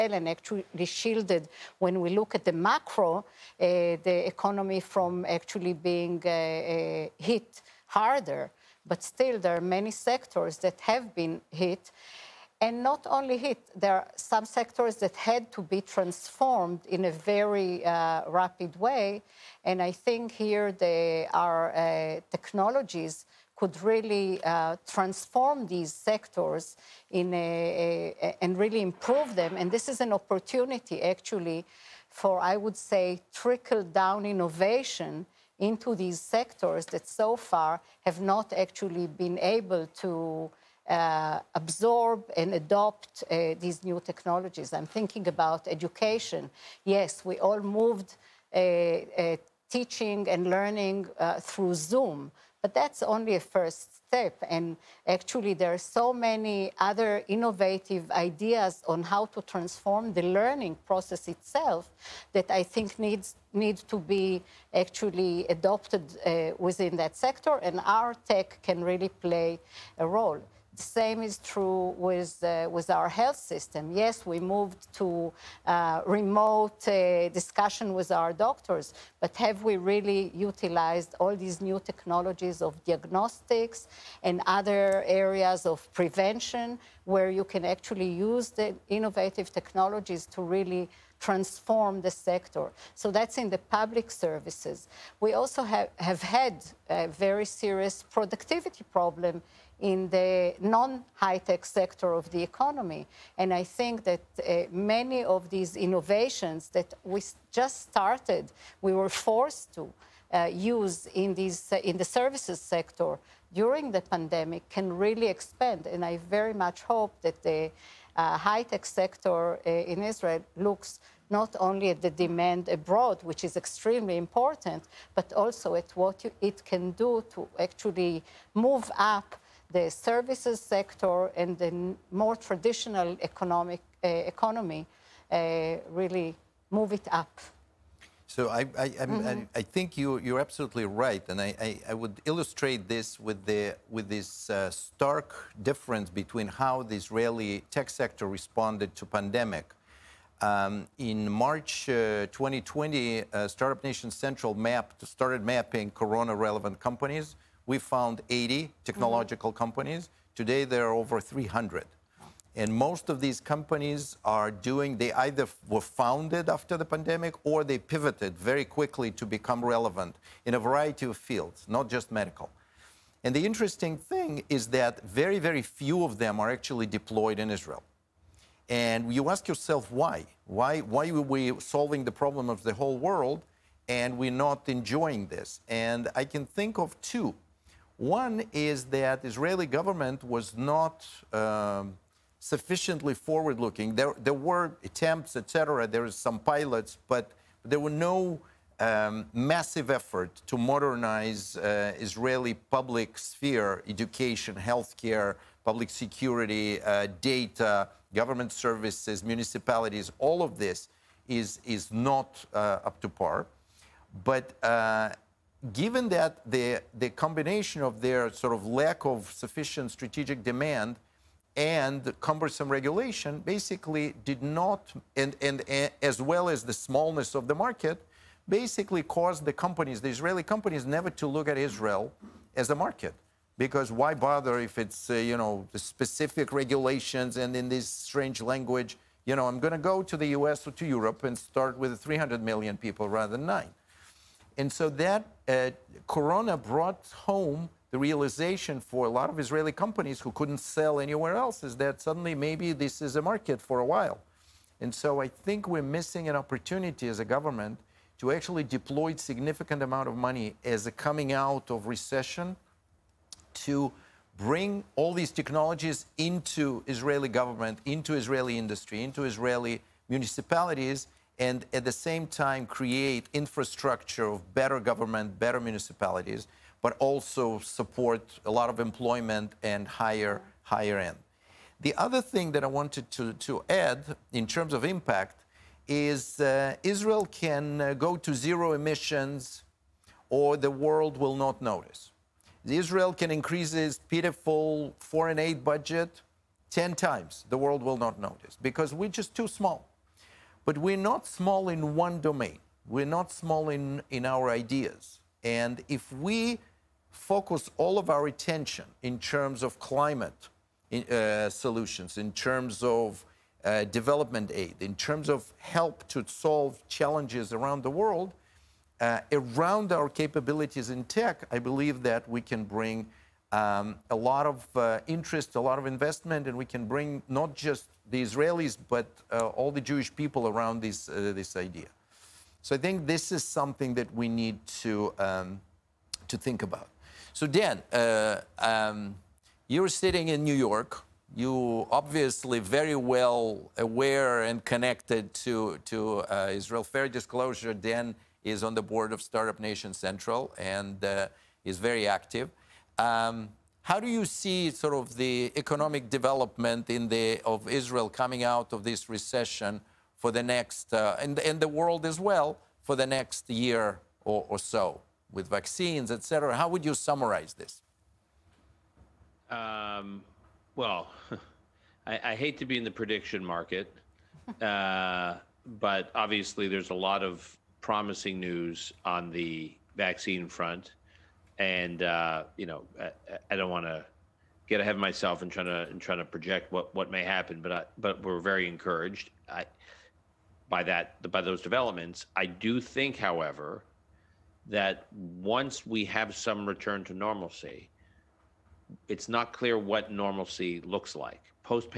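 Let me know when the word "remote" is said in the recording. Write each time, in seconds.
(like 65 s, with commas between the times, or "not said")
76 s.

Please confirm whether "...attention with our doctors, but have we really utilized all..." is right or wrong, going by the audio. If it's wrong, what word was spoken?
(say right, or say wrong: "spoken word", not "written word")
wrong: "discussion", not "attention".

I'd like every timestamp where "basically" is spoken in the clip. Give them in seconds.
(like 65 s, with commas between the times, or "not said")
223 s, 228 s.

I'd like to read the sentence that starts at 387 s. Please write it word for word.
But I, but we're very encouraged I, by that by those developments.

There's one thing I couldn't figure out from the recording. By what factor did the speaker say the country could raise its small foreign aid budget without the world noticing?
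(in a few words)
10 times.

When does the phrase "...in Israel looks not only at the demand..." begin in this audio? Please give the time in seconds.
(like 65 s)
119 s.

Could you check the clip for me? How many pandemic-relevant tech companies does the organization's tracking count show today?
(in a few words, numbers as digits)
Over 300.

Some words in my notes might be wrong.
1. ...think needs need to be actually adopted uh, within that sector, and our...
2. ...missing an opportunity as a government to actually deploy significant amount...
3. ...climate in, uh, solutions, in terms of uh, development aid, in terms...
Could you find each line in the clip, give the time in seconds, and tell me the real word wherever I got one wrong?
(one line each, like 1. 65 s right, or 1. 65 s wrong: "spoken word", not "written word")
1. 62 s right
2. 255 s right
3. 309 s right.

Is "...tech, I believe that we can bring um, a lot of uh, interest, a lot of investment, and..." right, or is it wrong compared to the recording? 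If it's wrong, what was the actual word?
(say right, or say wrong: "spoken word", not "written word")
right.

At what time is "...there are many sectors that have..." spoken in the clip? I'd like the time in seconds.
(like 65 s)
9 s.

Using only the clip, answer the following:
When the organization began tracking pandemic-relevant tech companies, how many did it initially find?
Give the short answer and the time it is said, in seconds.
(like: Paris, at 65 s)
80, at 158 s.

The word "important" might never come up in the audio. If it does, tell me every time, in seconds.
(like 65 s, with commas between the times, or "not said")
124 s.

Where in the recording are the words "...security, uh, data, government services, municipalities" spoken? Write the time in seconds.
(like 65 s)
205 s.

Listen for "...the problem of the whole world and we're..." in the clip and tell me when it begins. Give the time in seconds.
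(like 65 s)
182 s.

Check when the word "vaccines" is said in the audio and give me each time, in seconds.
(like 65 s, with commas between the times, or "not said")
365 s, 379 s.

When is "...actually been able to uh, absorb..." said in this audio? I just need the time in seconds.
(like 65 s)
38 s.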